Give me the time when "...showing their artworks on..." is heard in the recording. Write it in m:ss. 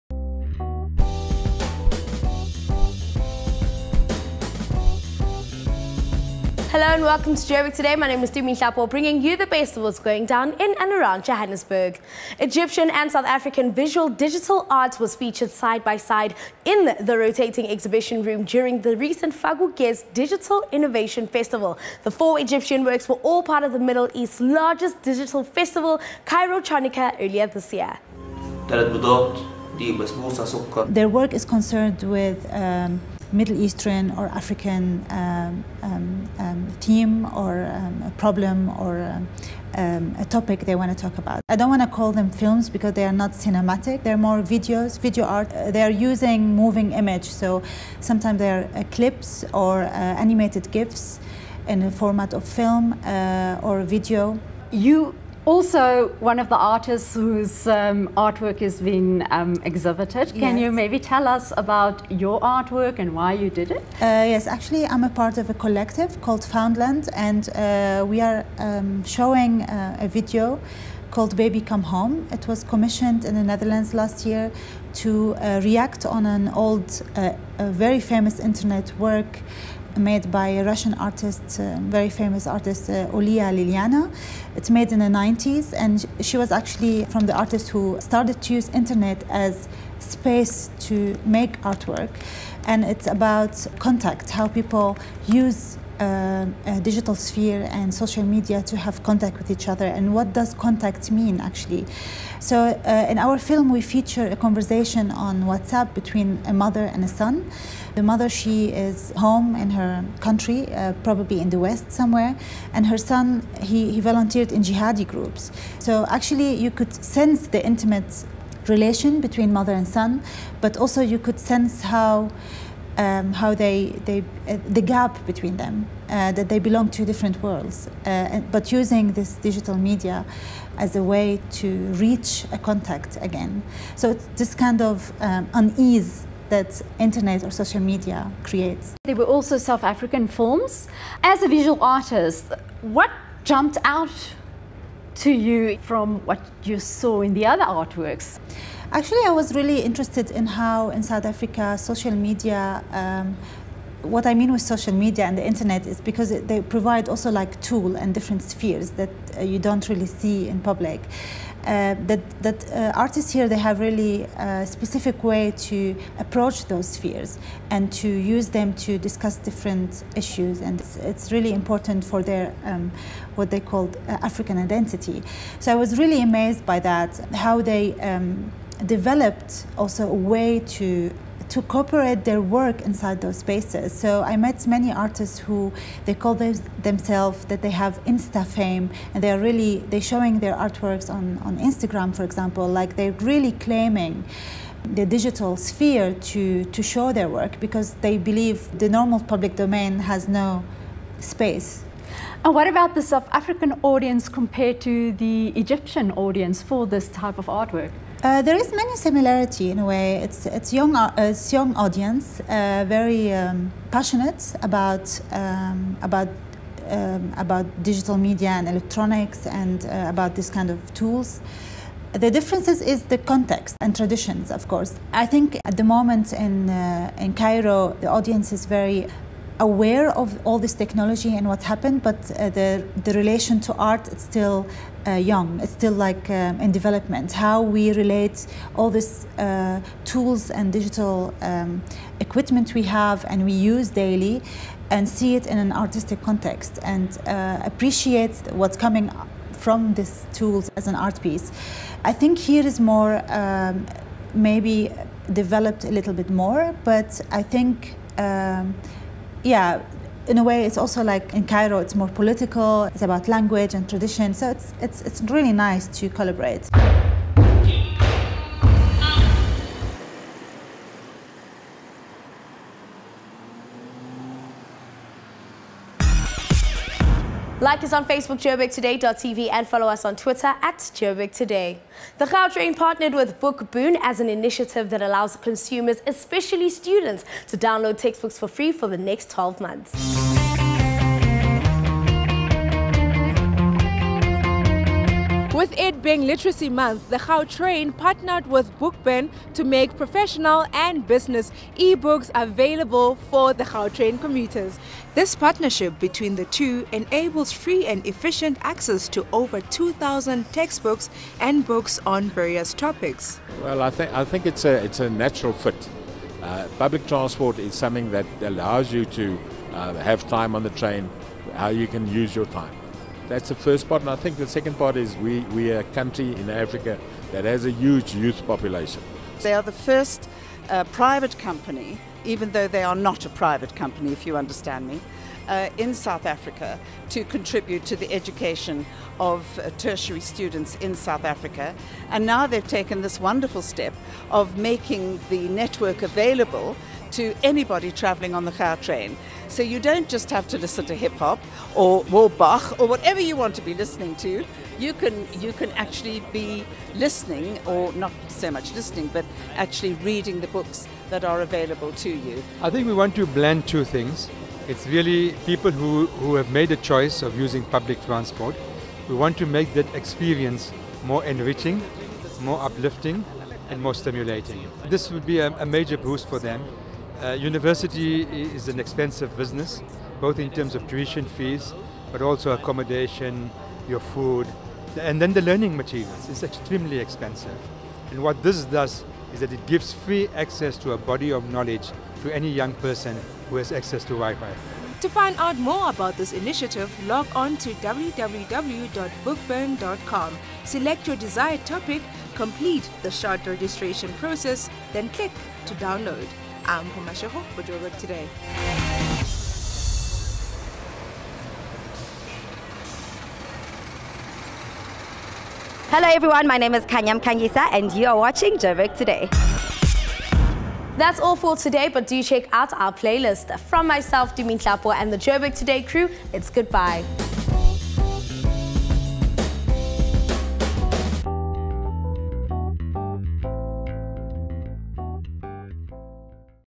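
3:10.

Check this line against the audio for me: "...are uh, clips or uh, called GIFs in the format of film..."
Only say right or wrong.
wrong.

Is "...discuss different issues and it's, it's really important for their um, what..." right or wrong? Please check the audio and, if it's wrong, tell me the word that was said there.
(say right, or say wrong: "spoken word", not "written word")
right.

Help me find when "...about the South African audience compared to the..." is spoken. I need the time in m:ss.
3:22.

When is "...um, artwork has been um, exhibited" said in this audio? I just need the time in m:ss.
0:57.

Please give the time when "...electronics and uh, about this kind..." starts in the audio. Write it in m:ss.
3:38.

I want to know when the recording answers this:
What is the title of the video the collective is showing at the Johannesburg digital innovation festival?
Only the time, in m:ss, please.
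1:11.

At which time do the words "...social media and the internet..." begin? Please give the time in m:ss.
2:34.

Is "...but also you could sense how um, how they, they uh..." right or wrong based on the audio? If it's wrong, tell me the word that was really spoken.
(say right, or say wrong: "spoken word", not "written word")
right.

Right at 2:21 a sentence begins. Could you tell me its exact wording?
As a visual artist, what jumped out to you from what you saw in the other artworks?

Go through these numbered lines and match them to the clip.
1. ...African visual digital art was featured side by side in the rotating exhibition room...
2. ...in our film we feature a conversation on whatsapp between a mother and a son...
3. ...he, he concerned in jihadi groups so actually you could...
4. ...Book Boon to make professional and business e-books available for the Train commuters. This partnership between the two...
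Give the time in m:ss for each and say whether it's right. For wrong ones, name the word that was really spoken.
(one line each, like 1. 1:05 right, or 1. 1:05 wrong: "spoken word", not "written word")
1. 0:13 right
2. 1:43 right
3. 1:53 wrong: "volunteered", not "concerned"
4. 4:58 right.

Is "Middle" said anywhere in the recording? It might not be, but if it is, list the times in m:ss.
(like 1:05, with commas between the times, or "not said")
0:23, 0:33.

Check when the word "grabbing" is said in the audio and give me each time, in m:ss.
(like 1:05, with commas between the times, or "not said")
not said.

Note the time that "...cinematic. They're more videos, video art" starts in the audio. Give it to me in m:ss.
0:43.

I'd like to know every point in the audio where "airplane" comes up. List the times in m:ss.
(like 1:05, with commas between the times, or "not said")
not said.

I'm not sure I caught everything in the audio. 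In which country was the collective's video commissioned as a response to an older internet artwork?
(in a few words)
the Netherlands.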